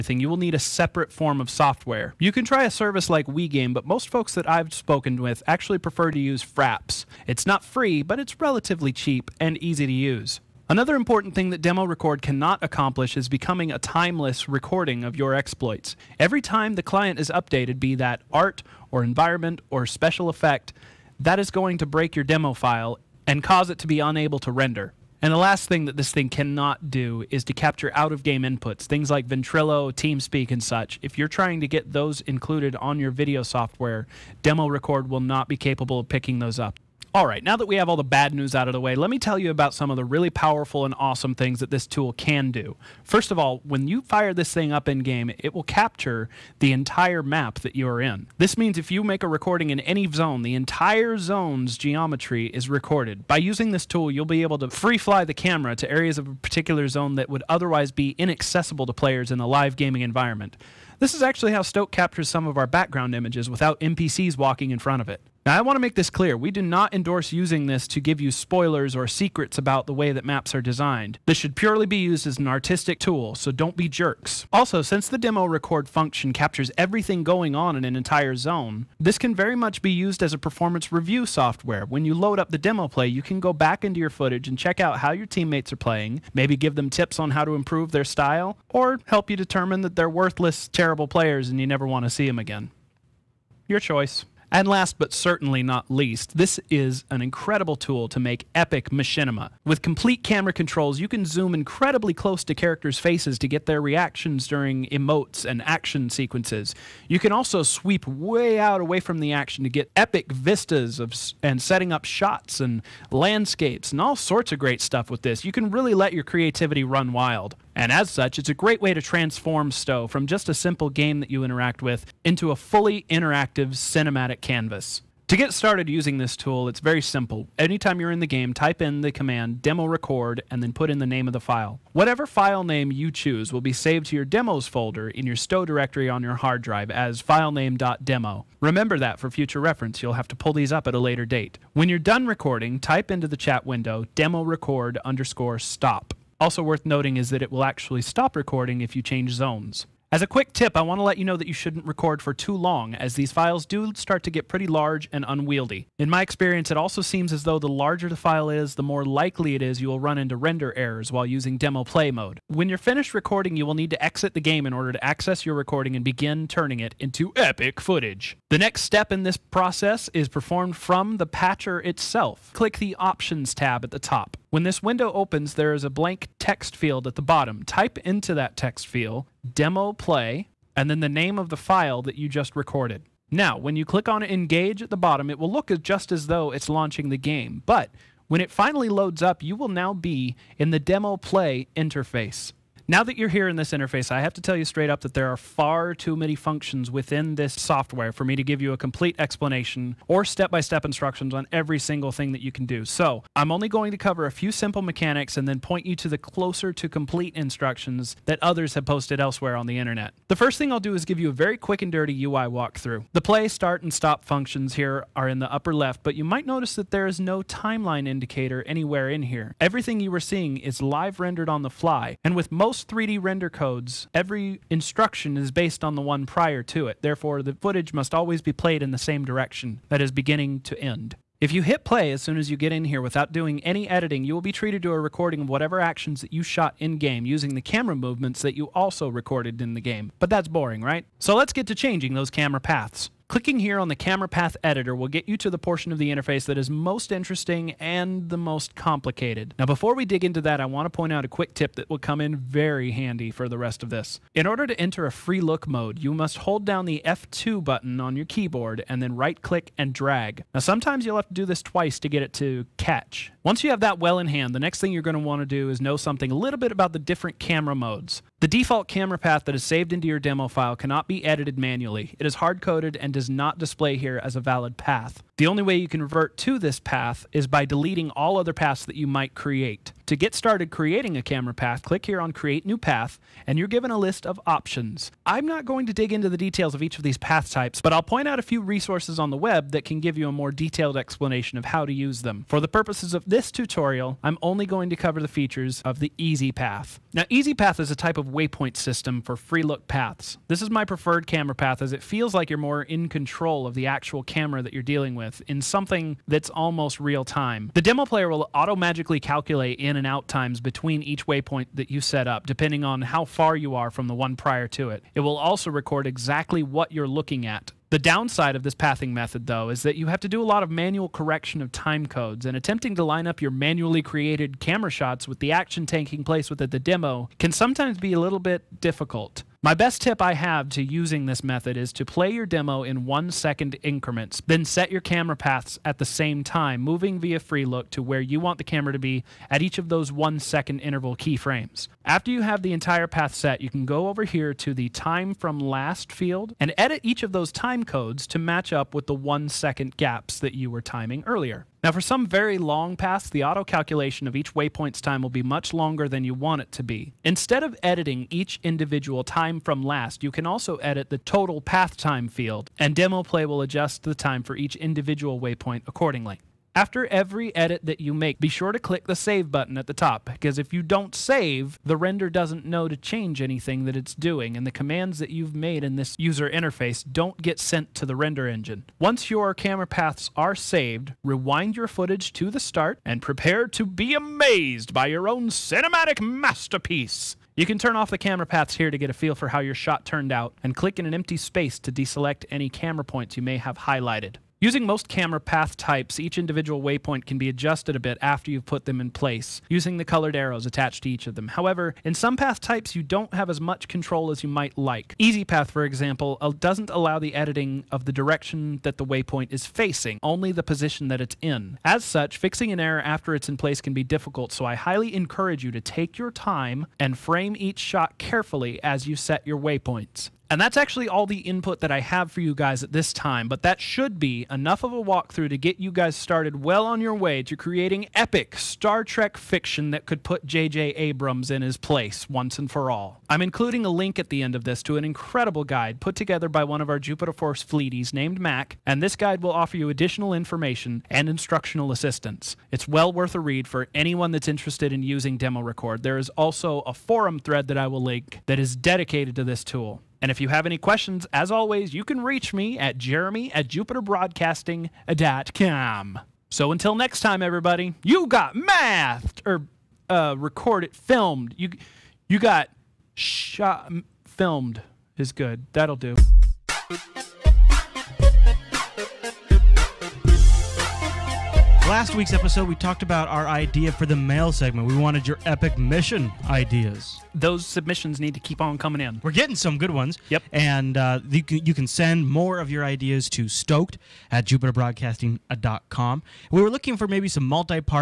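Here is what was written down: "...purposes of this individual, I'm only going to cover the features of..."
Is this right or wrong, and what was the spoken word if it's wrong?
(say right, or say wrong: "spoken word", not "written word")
wrong: "tutorial", not "individual".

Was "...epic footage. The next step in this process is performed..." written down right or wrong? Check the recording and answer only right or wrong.
right.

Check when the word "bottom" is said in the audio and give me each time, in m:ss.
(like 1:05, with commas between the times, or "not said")
2:57, 3:04.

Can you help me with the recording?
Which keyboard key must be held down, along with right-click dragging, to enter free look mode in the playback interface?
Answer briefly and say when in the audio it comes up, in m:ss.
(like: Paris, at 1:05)
F2, at 4:17.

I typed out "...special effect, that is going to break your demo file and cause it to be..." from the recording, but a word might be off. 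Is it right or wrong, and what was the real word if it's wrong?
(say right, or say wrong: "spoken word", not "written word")
right.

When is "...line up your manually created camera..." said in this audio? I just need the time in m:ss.
5:23.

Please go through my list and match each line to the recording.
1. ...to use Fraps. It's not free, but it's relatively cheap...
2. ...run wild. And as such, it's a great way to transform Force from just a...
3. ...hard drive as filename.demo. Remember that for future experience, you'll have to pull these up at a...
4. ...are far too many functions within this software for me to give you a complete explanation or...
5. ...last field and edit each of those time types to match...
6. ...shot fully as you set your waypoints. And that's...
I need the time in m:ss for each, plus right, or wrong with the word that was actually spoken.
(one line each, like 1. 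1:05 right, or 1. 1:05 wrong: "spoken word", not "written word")
1. 0:06 right
2. 1:56 wrong: "STO", not "Force"
3. 2:16 wrong: "reference", not "experience"
4. 3:15 right
5. 5:45 wrong: "codes", not "types"
6. 6:57 wrong: "carefully", not "fully".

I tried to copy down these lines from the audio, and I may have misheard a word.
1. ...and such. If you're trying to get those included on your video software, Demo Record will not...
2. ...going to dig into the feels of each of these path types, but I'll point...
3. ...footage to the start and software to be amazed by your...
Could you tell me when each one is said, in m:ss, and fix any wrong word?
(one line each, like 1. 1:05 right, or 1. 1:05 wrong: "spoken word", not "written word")
1. 0:30 right
2. 4:45 wrong: "details", not "feels"
3. 6:21 wrong: "prepare", not "software".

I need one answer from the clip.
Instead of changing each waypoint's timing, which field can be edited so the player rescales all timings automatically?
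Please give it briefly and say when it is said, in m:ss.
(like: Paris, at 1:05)
total path time, at 6:01.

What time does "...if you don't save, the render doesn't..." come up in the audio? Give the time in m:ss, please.
6:10.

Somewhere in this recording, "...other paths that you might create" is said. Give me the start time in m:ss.
4:38.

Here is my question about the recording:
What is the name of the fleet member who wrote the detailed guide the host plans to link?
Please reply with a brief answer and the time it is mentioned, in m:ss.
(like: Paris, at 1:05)
Mac, at 7:18.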